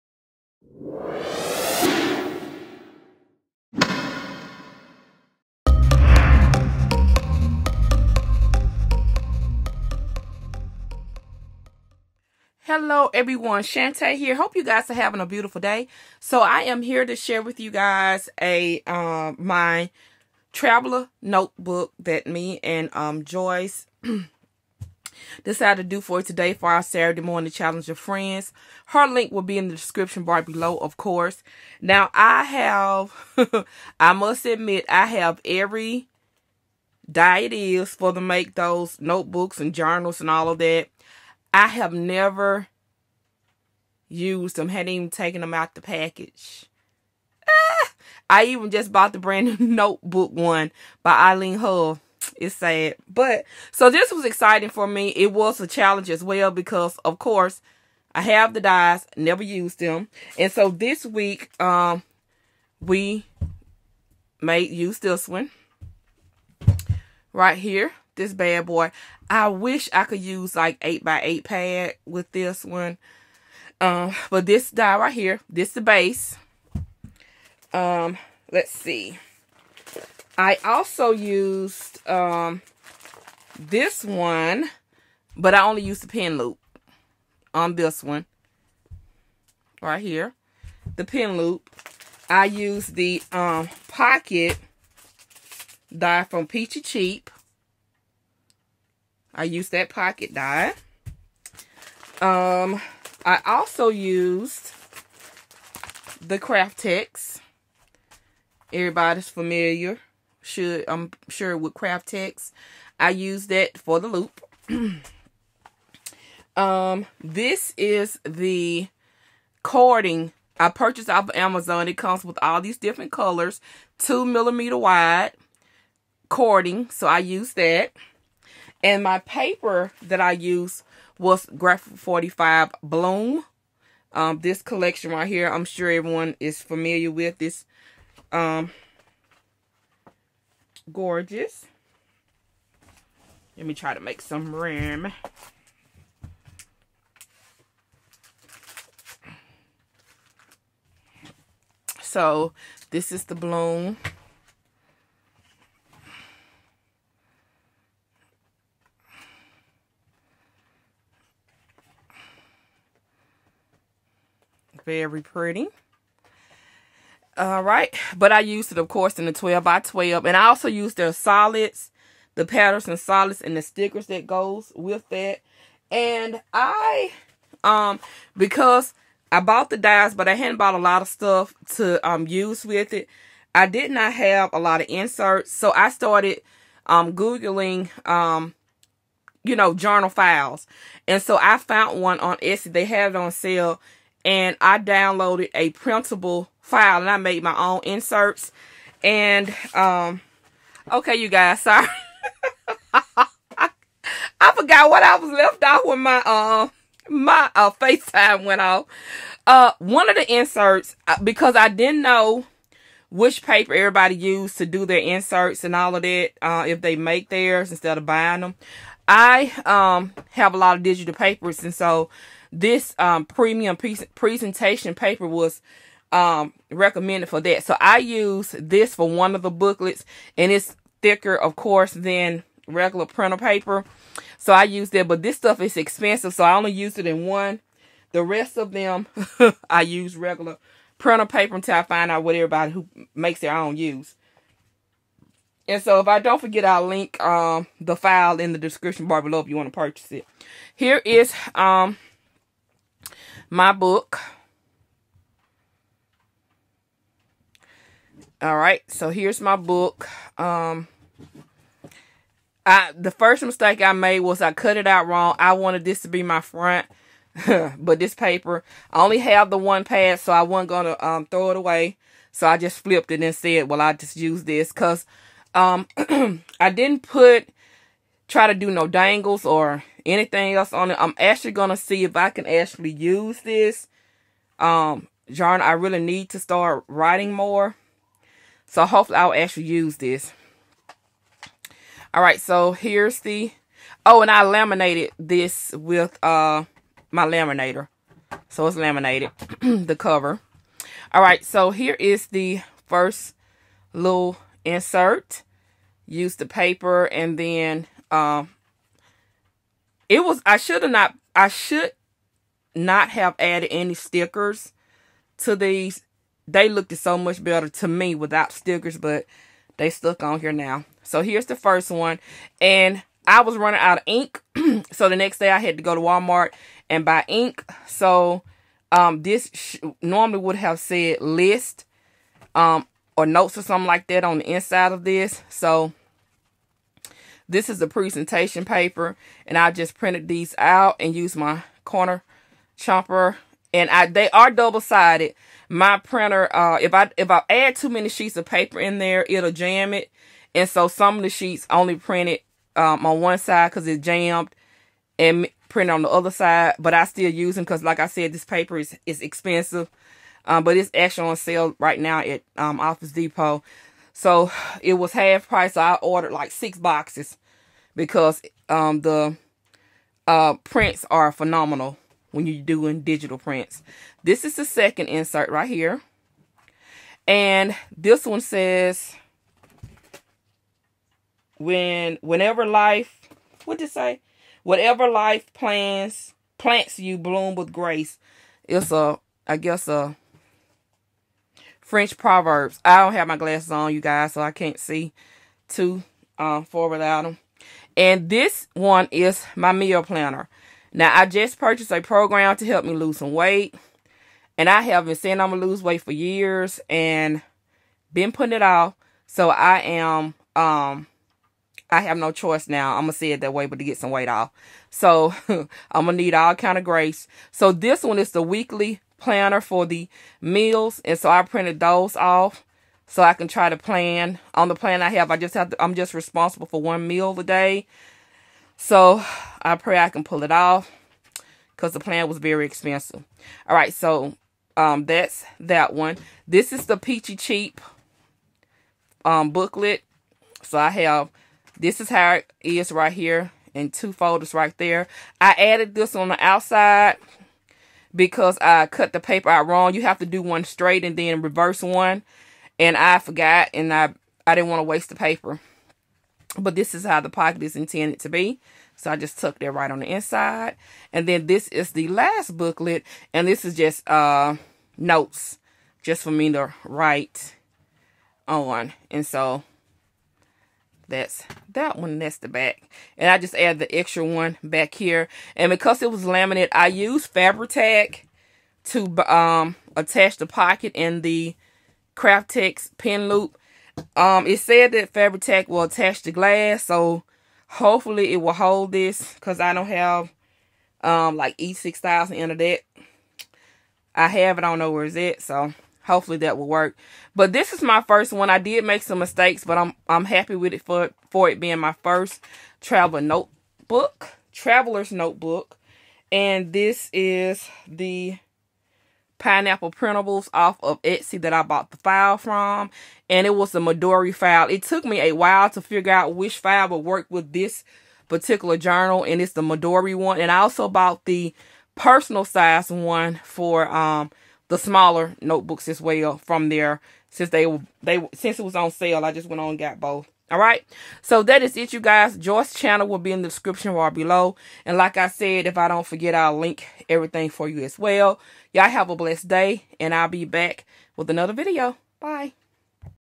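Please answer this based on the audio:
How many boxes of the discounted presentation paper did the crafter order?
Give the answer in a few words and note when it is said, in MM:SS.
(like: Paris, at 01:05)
6, at 06:06.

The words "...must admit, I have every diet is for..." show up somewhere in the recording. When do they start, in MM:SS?
00:34.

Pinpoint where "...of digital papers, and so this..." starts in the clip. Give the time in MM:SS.
03:40.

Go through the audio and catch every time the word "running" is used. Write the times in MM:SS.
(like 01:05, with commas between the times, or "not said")
05:23.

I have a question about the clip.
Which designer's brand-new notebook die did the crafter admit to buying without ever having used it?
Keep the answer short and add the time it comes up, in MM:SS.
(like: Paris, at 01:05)
Eileen Hull, at 00:51.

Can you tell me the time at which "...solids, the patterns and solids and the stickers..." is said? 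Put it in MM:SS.
02:51.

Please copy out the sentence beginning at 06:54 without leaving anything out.
So I'm going to need all kind of grace.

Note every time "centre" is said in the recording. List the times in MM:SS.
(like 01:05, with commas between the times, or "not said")
not said.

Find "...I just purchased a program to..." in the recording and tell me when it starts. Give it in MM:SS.
06:41.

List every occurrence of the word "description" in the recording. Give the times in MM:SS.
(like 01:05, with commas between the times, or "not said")
00:29, 04:08, 08:53.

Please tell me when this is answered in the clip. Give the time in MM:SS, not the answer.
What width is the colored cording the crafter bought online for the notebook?
02:03.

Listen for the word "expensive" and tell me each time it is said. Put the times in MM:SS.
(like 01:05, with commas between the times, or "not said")
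03:55, 05:59, 07:12.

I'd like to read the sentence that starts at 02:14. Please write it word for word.
Um, this collection right here, I'm sure everyone is familiar with this.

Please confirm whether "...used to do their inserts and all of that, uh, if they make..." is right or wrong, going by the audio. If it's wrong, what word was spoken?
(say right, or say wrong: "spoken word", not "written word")
right.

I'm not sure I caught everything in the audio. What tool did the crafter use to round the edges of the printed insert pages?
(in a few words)
corner chomper.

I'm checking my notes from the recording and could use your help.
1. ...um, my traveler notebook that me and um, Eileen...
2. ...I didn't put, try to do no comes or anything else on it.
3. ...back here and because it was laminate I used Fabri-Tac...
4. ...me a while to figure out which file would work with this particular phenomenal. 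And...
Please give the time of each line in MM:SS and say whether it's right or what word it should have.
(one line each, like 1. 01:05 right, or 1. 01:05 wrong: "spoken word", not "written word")
1. 00:18 wrong: "Joyce", not "Eileen"
2. 04:36 wrong: "dangles", not "comes"
3. 07:54 right
4. 08:35 wrong: "journal", not "phenomenal".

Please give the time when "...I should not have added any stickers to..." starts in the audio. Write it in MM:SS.
05:11.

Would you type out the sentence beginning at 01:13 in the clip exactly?
Um, but this die right here, this the base.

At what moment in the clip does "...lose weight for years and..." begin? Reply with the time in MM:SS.
06:45.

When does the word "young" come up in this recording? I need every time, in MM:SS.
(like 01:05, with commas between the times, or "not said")
not said.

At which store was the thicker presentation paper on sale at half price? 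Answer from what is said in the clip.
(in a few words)
Office Depot.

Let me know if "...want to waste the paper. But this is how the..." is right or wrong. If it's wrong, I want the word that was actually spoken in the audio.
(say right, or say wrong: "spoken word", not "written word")
right.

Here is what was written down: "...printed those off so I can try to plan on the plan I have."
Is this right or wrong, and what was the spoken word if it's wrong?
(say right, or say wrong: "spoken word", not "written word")
right.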